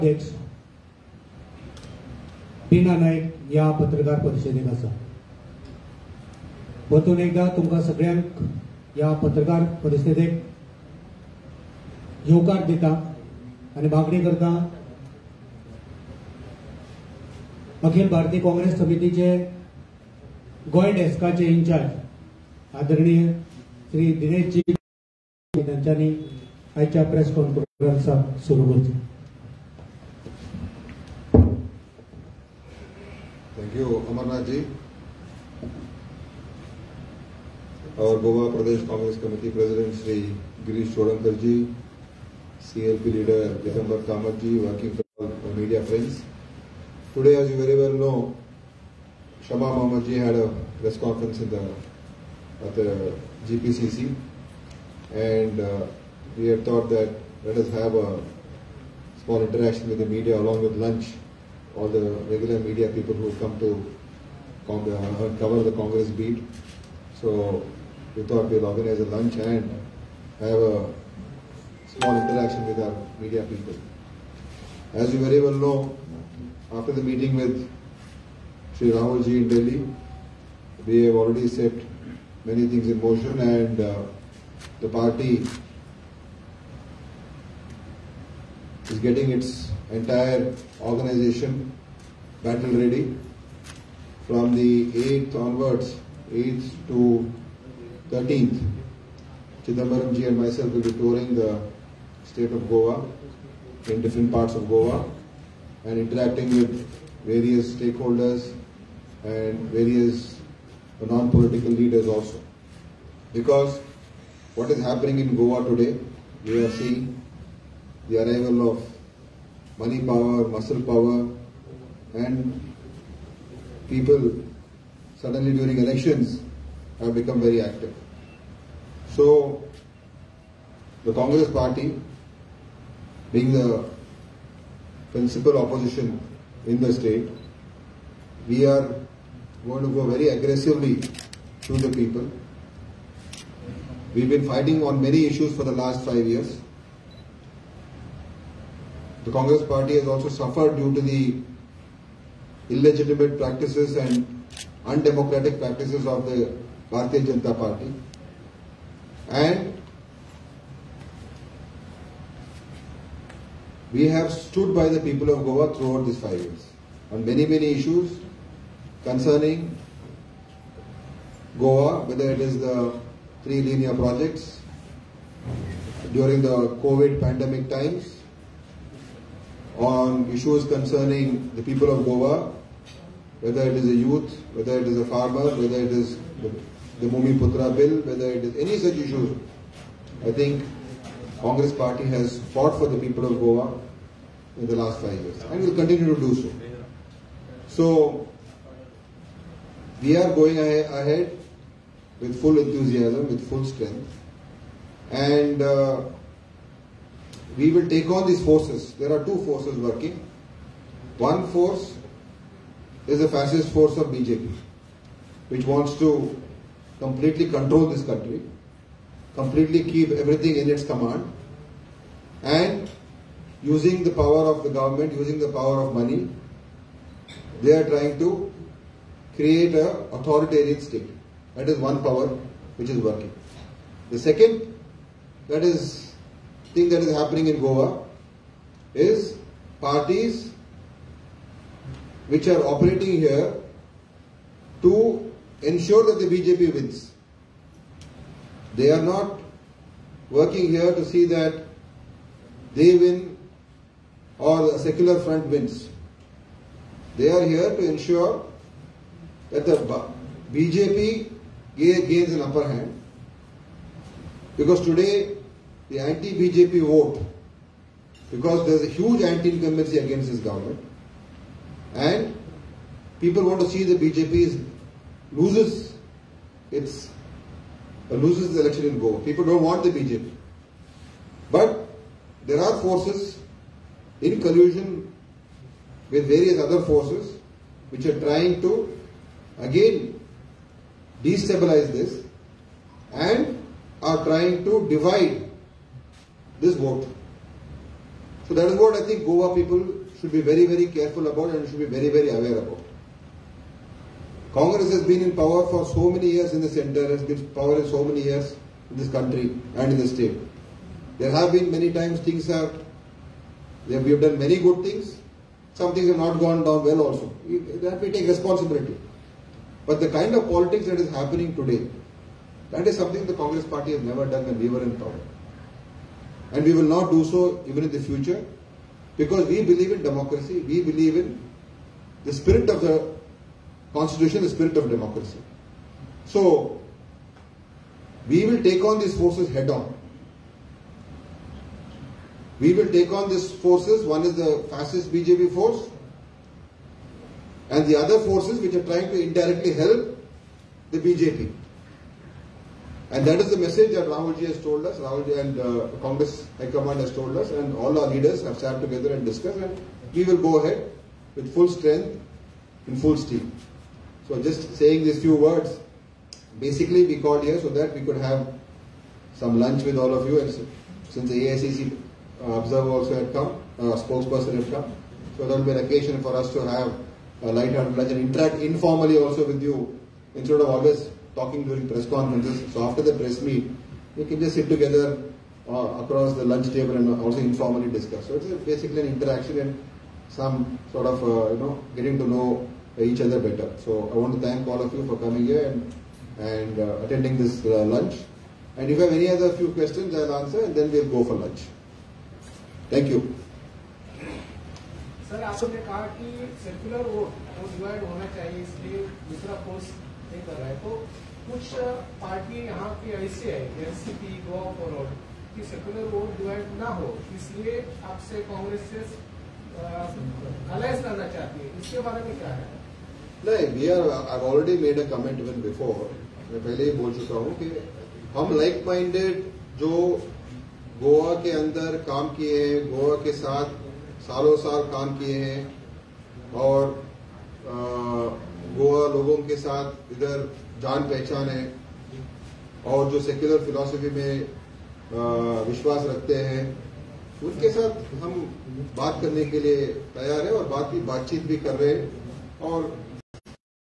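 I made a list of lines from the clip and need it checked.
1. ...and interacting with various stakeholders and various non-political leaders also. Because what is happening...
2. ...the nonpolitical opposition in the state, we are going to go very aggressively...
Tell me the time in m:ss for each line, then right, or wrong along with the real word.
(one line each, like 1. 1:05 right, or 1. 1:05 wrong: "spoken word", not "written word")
1. 1:45 right
2. 2:13 wrong: "principal", not "nonpolitical".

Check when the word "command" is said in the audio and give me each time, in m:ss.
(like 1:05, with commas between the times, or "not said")
3:40, 5:56.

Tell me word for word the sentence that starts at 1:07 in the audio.
So we thought we'll organize a lunch and have a small interaction with our media people.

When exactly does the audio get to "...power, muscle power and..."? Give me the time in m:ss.
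1:59.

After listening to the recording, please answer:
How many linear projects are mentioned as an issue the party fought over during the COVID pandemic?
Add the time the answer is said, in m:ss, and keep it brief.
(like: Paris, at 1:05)
3, at 2:53.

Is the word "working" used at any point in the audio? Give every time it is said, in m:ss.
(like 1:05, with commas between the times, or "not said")
3:29, 3:52, 4:10.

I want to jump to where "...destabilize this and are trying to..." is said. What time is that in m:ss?
4:51.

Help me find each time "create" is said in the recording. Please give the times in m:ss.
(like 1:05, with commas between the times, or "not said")
3:49.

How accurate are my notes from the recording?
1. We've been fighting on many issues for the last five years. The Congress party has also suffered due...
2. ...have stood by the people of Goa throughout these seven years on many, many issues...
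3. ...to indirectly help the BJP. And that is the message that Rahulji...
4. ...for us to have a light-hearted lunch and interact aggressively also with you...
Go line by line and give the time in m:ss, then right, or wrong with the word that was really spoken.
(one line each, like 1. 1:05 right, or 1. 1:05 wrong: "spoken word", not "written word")
1. 2:24 right
2. 2:44 wrong: "five", not "seven"
3. 5:49 right
4. 6:16 wrong: "informally", not "aggressively".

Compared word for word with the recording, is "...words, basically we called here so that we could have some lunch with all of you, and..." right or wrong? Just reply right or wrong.
right.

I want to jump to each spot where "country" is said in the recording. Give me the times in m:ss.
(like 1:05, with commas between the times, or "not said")
3:38, 5:09.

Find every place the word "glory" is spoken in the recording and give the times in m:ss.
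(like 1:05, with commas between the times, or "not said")
not said.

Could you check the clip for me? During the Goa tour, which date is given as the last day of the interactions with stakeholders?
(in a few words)
13th.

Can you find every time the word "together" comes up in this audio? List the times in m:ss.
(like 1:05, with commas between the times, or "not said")
5:58, 6:24.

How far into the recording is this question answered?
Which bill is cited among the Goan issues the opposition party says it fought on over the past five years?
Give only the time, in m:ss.
3:07.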